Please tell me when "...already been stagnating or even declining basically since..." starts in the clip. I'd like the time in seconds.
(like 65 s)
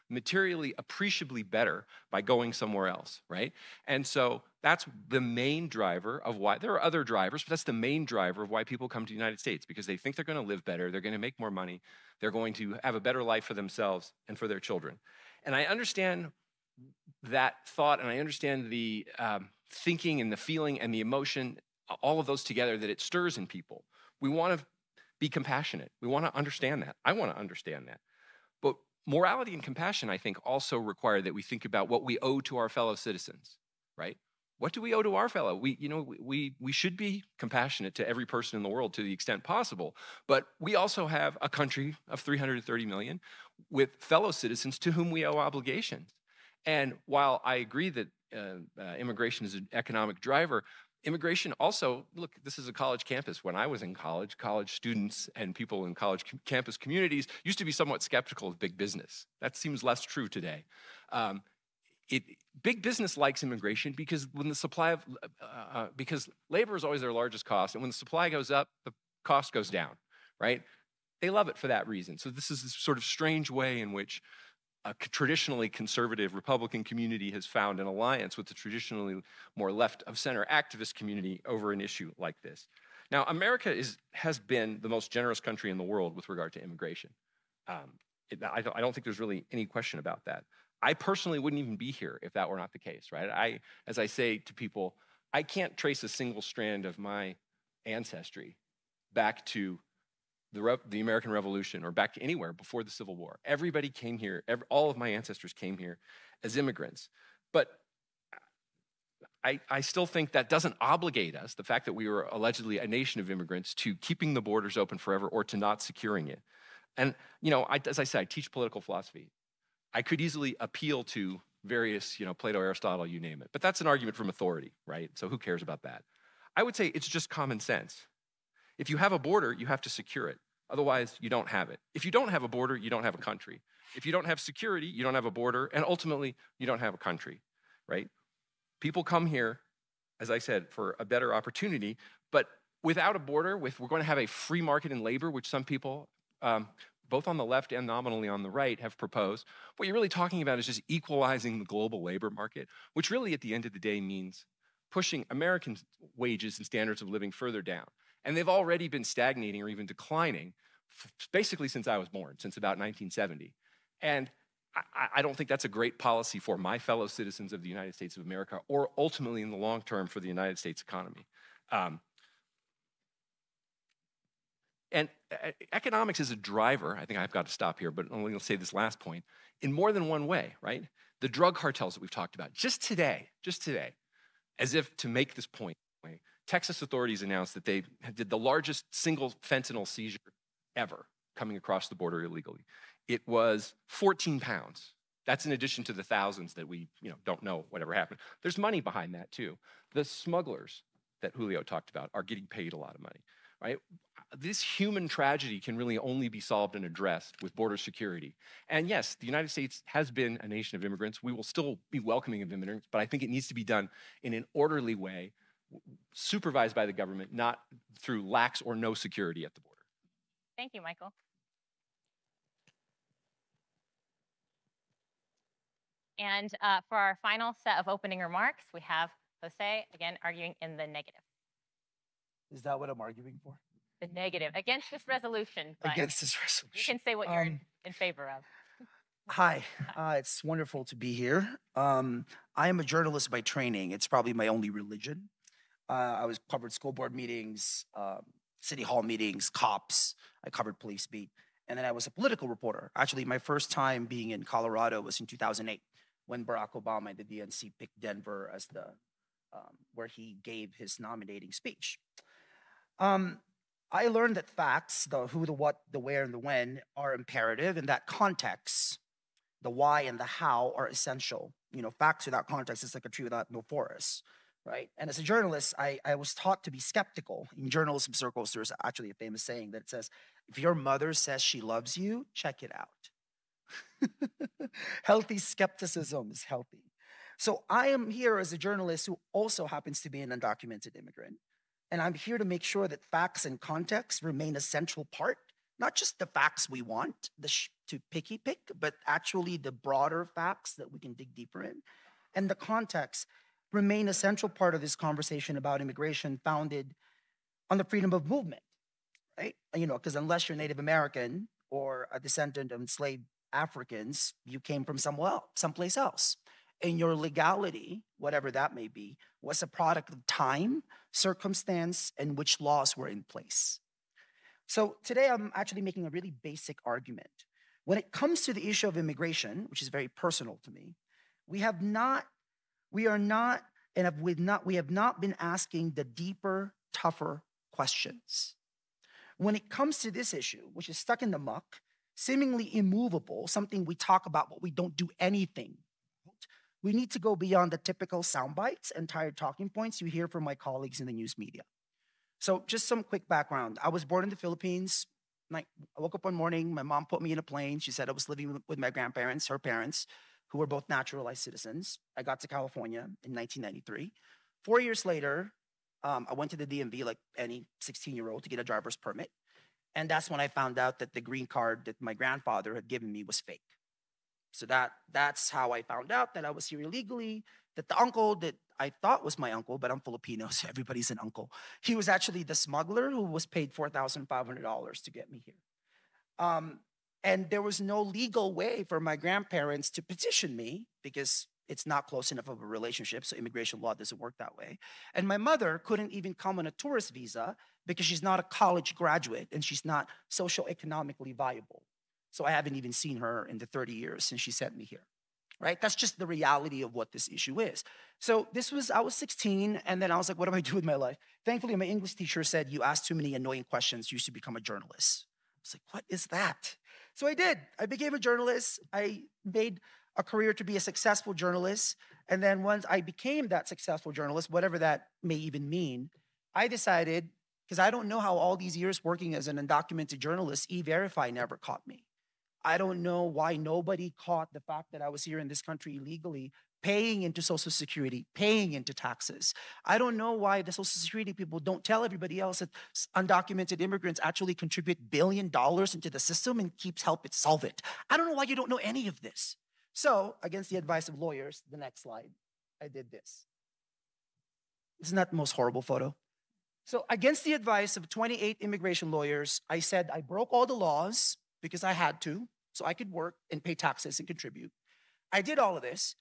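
158 s.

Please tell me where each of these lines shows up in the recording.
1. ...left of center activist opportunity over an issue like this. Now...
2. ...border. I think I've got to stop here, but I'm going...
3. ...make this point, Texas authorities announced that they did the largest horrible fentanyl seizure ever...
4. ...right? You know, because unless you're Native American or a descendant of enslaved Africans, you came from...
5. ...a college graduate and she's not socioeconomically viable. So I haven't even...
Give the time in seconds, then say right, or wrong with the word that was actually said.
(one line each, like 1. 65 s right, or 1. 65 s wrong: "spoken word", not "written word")
1. 79 s wrong: "community", not "opportunity"
2. 176 s wrong: "driver", not "border"
3. 185 s wrong: "single", not "horrible"
4. 309 s right
5. 398 s right.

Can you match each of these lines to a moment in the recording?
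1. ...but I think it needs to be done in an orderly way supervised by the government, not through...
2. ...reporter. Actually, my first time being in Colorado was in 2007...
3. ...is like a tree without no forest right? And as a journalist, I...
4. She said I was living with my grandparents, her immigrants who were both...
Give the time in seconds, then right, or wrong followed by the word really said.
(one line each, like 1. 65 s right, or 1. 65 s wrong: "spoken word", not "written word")
1. 212 s right
2. 252 s wrong: "2008", not "2007"
3. 272 s right
4. 357 s wrong: "parents", not "immigrants".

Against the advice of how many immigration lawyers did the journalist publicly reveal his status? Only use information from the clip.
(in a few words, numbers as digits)
28.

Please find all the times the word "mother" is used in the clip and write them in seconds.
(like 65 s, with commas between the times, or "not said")
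280 s, 395 s.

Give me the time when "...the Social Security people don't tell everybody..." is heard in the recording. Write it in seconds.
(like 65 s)
440 s.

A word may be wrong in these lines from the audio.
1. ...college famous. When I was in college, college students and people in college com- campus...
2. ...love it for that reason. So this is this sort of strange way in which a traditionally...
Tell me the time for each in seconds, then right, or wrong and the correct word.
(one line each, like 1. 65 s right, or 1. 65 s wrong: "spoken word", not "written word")
1. 52 s wrong: "campus", not "famous"
2. 71 s right.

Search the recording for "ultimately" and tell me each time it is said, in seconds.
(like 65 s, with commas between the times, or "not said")
135 s, 168 s.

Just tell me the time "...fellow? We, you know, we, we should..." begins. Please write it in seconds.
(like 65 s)
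35 s.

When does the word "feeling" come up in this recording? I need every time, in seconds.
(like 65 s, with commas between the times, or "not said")
20 s.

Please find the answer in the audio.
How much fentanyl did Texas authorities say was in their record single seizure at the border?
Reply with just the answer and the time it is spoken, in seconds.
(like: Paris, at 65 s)
14 pounds, at 193 s.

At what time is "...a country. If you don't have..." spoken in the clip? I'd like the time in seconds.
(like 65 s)
133 s.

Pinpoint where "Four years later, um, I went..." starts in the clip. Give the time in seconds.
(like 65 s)
364 s.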